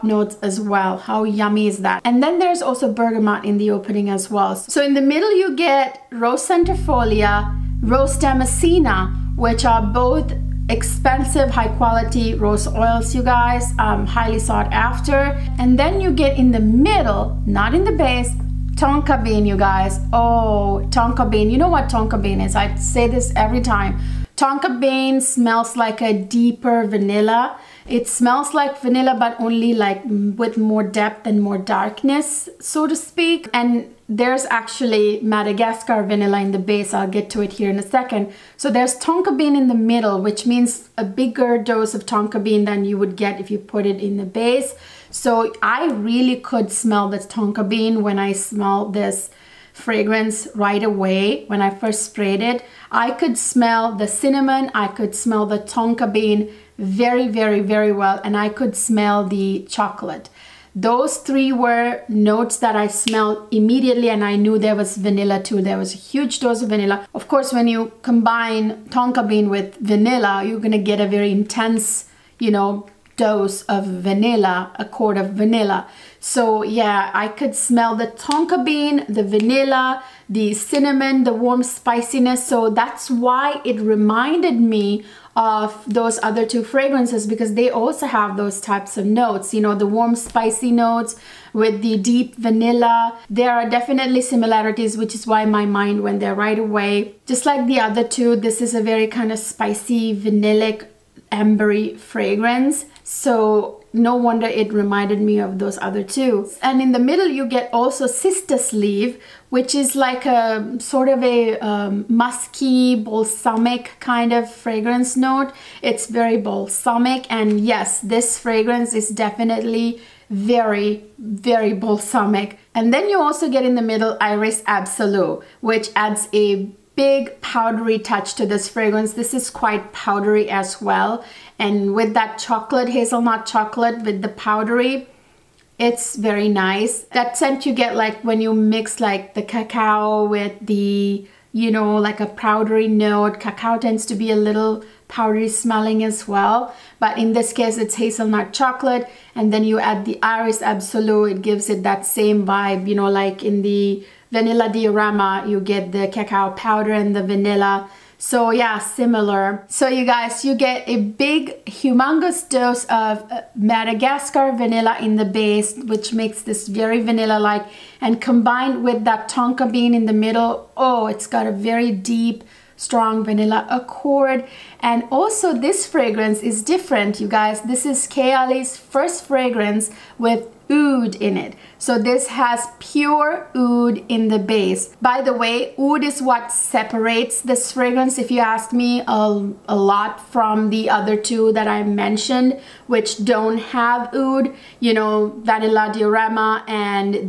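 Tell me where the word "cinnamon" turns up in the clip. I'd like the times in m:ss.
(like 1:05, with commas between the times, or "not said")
0:54, 1:20.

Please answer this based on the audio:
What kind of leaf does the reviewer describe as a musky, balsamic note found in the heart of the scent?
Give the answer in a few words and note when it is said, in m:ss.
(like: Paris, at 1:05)
Cistus leaf, at 1:48.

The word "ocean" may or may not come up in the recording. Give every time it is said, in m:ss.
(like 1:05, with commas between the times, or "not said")
not said.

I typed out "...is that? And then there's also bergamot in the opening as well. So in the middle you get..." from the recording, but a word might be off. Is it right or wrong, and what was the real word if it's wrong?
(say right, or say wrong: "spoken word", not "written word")
right.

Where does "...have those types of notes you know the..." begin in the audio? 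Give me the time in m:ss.
1:28.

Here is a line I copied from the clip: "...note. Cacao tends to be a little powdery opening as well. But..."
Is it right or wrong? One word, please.
wrong.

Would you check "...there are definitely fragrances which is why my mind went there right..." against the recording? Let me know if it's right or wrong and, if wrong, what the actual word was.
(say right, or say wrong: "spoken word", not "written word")
wrong: "similarities", not "fragrances".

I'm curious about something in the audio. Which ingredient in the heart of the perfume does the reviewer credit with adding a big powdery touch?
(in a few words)
Iris Absolue.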